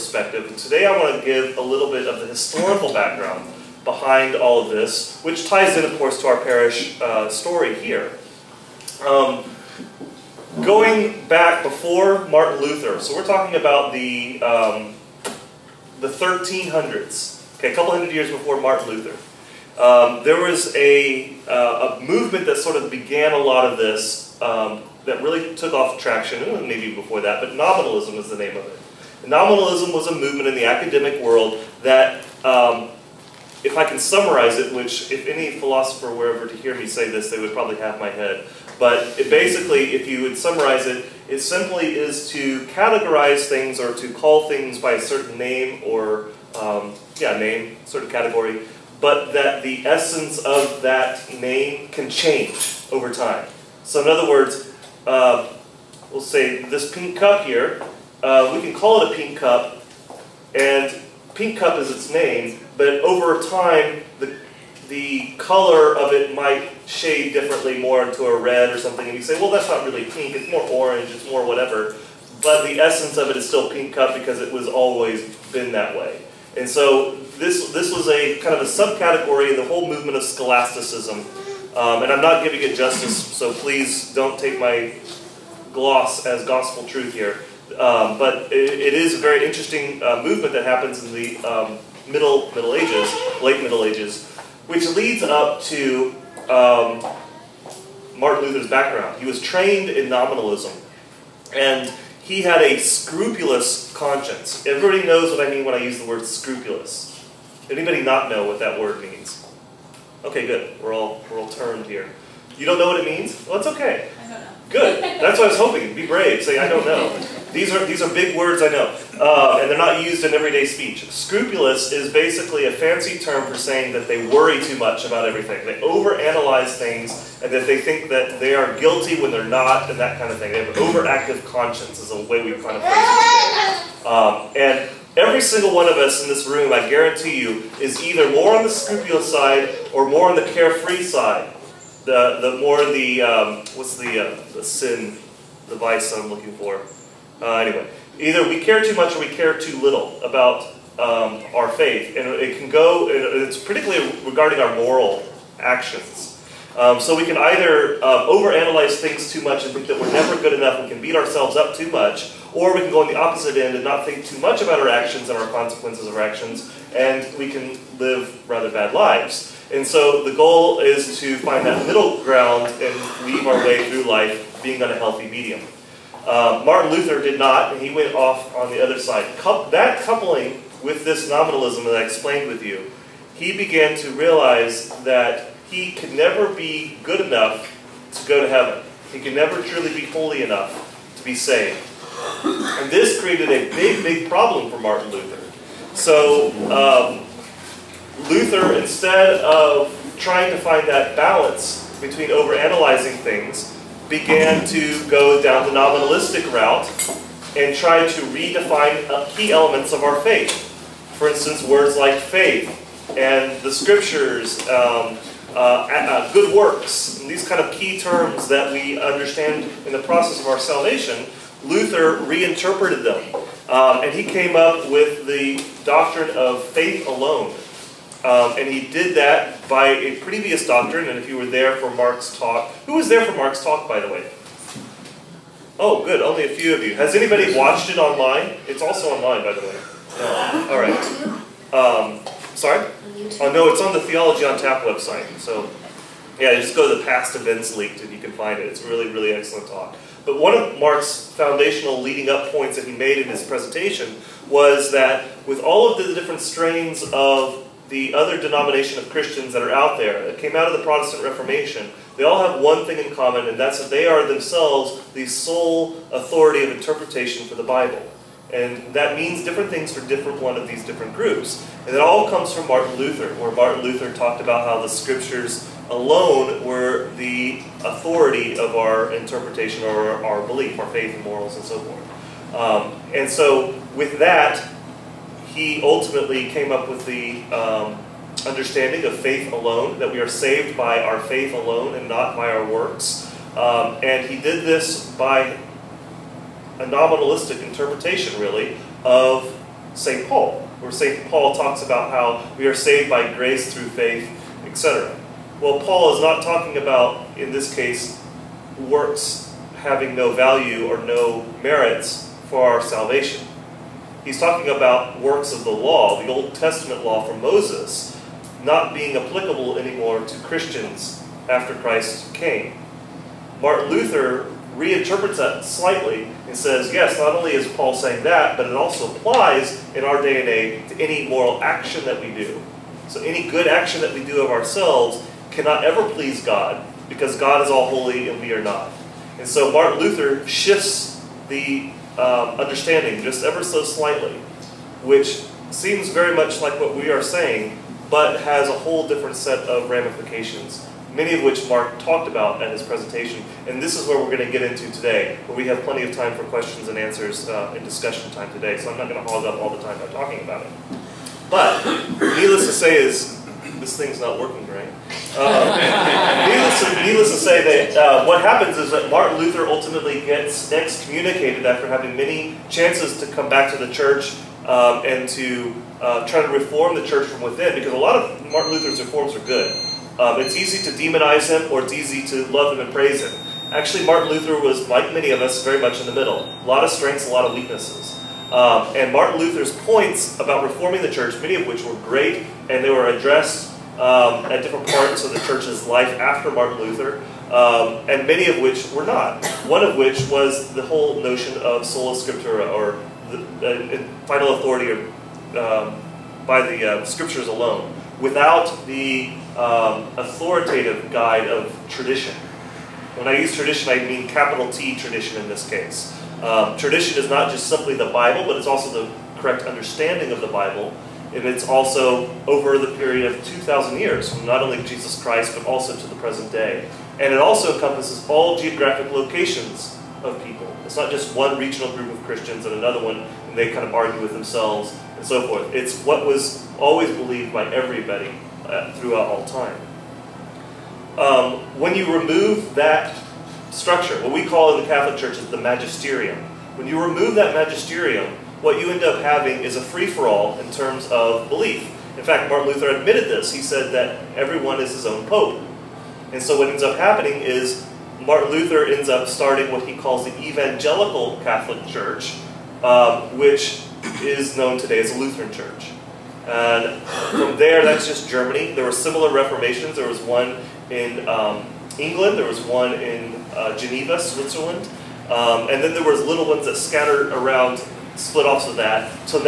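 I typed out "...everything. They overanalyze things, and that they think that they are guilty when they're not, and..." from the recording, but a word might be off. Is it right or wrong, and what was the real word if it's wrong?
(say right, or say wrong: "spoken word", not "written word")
right.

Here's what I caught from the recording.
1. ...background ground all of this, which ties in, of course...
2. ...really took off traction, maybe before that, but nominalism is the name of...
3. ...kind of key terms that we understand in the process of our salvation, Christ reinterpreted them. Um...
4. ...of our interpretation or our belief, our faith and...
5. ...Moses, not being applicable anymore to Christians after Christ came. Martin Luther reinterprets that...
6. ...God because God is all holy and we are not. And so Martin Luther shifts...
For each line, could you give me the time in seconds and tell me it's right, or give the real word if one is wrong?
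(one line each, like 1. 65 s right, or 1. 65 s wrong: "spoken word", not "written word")
1. 2 s wrong: "behind", not "ground"
2. 25 s right
3. 217 s wrong: "Luther", not "Christ"
4. 278 s right
5. 317 s right
6. 336 s right.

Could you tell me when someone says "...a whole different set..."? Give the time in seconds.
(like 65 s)
348 s.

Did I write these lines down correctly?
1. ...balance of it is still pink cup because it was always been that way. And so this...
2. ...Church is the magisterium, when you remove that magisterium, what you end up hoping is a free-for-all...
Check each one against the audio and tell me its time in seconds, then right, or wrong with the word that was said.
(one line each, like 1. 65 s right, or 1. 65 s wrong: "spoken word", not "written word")
1. 72 s wrong: "essence", not "balance"
2. 445 s wrong: "having", not "hoping".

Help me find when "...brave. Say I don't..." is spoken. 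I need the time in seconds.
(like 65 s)
116 s.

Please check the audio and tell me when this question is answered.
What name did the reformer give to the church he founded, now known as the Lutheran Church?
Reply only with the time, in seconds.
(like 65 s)
460 s.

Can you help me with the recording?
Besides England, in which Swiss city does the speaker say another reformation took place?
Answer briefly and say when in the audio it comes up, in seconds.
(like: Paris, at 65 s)
Geneva, at 473 s.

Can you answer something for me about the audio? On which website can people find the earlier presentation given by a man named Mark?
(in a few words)
Theology on Tap website.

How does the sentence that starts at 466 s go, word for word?
And from there, that's just Germany.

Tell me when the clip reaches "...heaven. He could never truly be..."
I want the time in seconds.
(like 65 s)
188 s.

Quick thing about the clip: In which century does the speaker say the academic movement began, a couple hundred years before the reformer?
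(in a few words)
1300s.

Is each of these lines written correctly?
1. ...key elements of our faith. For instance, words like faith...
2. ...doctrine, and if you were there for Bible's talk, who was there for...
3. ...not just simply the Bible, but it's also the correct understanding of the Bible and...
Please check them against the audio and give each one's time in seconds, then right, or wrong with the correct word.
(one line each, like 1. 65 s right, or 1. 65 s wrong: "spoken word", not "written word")
1. 209 s right
2. 230 s wrong: "Mark", not "Bible"
3. 417 s right.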